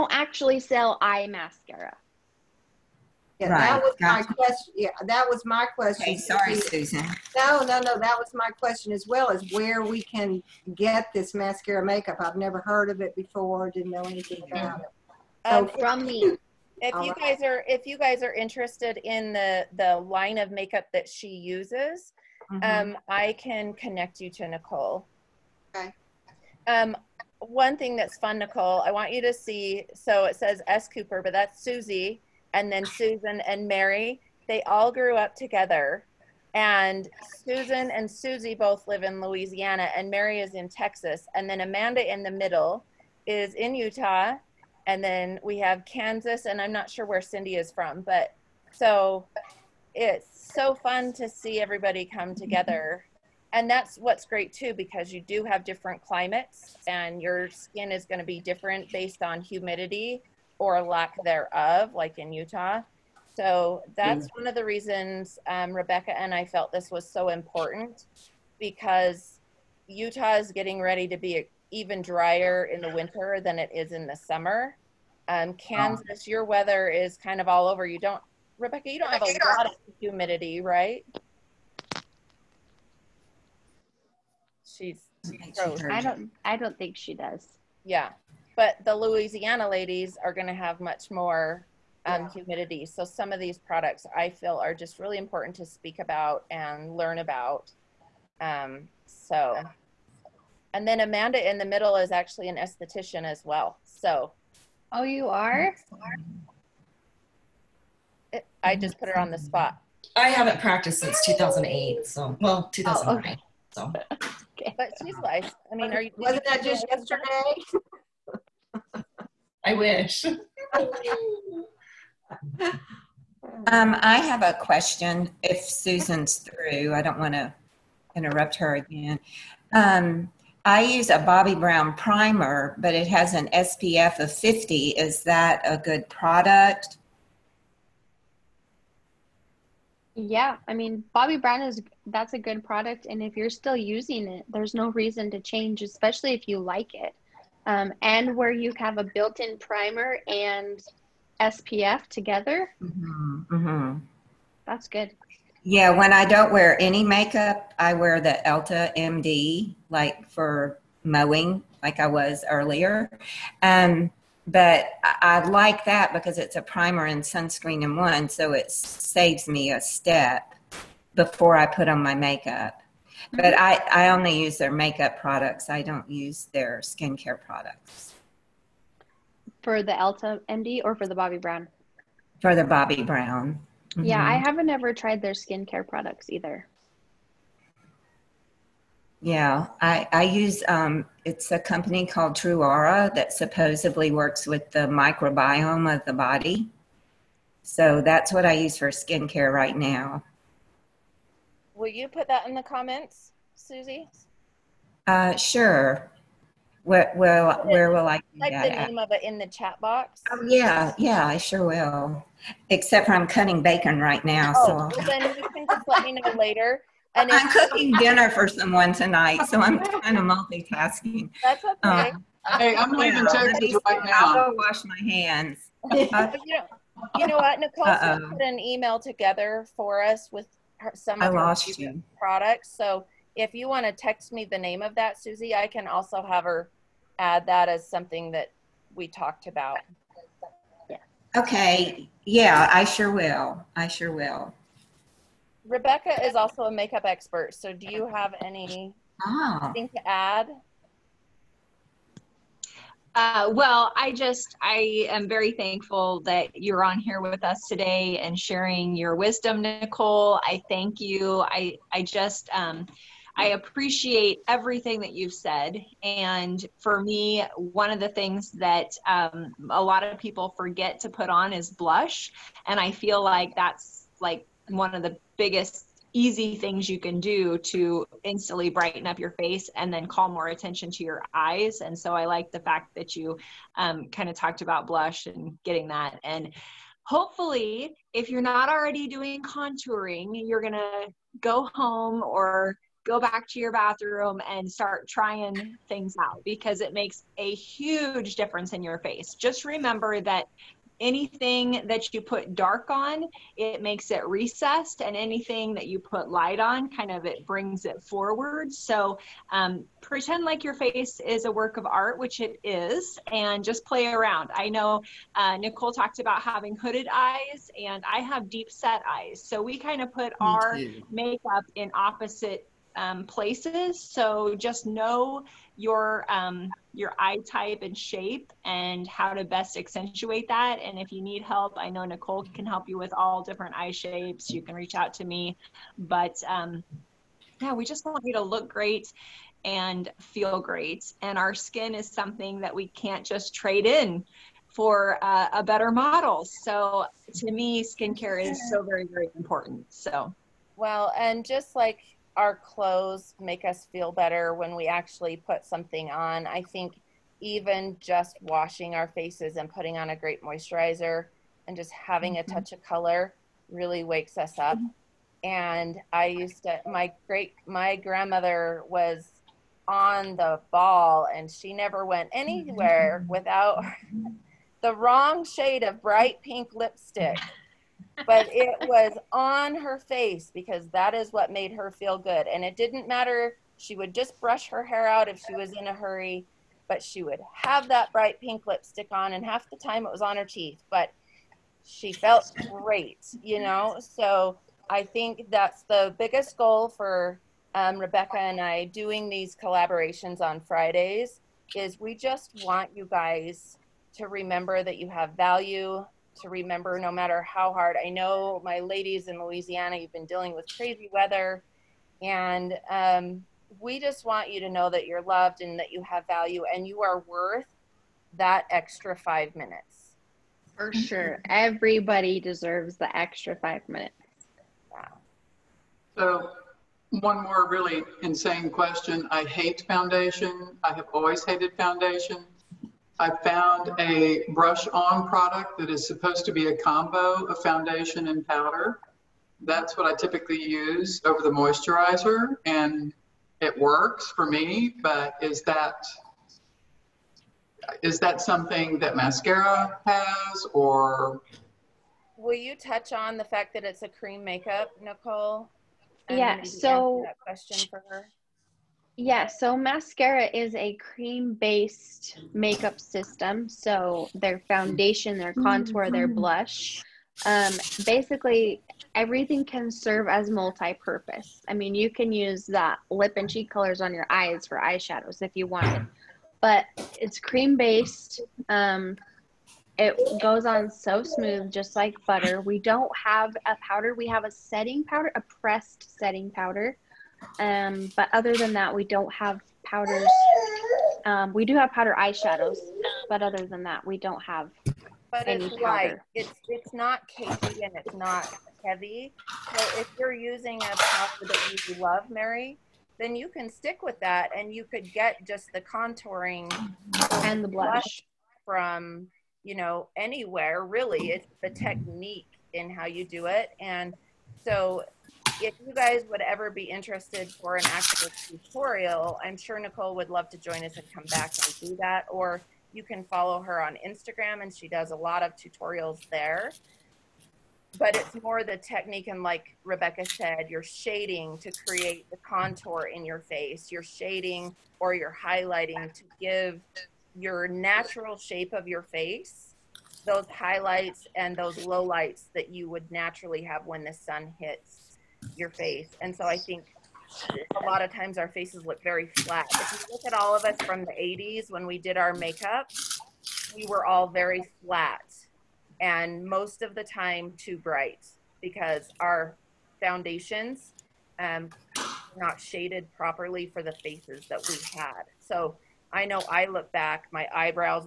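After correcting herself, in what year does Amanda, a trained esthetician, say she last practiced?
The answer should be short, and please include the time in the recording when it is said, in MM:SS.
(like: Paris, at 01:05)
2009, at 01:52.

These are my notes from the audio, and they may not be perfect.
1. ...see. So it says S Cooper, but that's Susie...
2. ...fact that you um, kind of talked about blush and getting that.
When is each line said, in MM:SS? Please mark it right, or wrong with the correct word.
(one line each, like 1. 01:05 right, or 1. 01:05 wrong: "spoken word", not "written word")
1. 00:29 right
2. 04:42 right.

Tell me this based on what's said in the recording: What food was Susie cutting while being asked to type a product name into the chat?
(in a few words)
Bacon.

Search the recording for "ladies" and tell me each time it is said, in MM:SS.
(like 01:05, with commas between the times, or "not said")
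01:29, 06:48.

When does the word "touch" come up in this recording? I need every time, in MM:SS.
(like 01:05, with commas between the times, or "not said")
06:02, 07:32.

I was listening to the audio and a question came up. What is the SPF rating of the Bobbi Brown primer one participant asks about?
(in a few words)
50.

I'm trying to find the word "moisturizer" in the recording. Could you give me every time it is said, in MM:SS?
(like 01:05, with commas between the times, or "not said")
06:00, 07:21.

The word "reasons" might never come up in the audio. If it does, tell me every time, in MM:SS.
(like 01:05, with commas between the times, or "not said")
01:04, 02:24.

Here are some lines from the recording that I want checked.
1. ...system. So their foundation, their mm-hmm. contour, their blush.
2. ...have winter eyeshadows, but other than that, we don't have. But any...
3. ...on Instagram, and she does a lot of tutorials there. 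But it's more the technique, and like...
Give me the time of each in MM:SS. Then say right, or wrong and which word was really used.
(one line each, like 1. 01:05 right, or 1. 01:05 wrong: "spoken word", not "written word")
1. 07:42 right
2. 08:11 wrong: "powder", not "winter"
3. 08:43 right.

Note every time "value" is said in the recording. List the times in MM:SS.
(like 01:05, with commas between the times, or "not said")
06:45, 06:56.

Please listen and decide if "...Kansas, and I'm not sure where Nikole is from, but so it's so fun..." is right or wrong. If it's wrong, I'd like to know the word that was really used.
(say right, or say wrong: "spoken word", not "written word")
wrong: "Cindy", not "Nikole".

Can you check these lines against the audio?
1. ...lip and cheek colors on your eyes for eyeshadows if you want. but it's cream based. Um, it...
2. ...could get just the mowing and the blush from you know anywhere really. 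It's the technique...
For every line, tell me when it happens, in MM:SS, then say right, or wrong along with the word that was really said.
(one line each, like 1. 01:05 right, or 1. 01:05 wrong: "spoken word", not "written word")
1. 07:53 right
2. 08:24 wrong: "contouring", not "mowing".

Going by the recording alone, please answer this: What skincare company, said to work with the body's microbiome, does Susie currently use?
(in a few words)
Truara.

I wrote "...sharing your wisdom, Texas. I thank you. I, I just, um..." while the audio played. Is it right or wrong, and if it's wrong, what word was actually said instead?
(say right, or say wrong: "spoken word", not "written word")
wrong: "Nikole", not "Texas".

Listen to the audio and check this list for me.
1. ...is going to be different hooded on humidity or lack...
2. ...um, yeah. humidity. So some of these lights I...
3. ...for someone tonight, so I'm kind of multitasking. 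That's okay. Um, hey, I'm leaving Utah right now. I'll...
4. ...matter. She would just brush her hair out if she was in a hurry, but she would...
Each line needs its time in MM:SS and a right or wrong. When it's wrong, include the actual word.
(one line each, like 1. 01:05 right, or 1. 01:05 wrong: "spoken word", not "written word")
1. 00:57 wrong: "based", not "hooded"
2. 01:32 wrong: "products", not "lights"
3. 03:38 wrong: "Texas", not "Utah"
4. 06:23 right.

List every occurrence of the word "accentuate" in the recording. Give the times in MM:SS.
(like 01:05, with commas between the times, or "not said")
05:29.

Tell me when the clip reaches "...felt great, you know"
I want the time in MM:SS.
06:32.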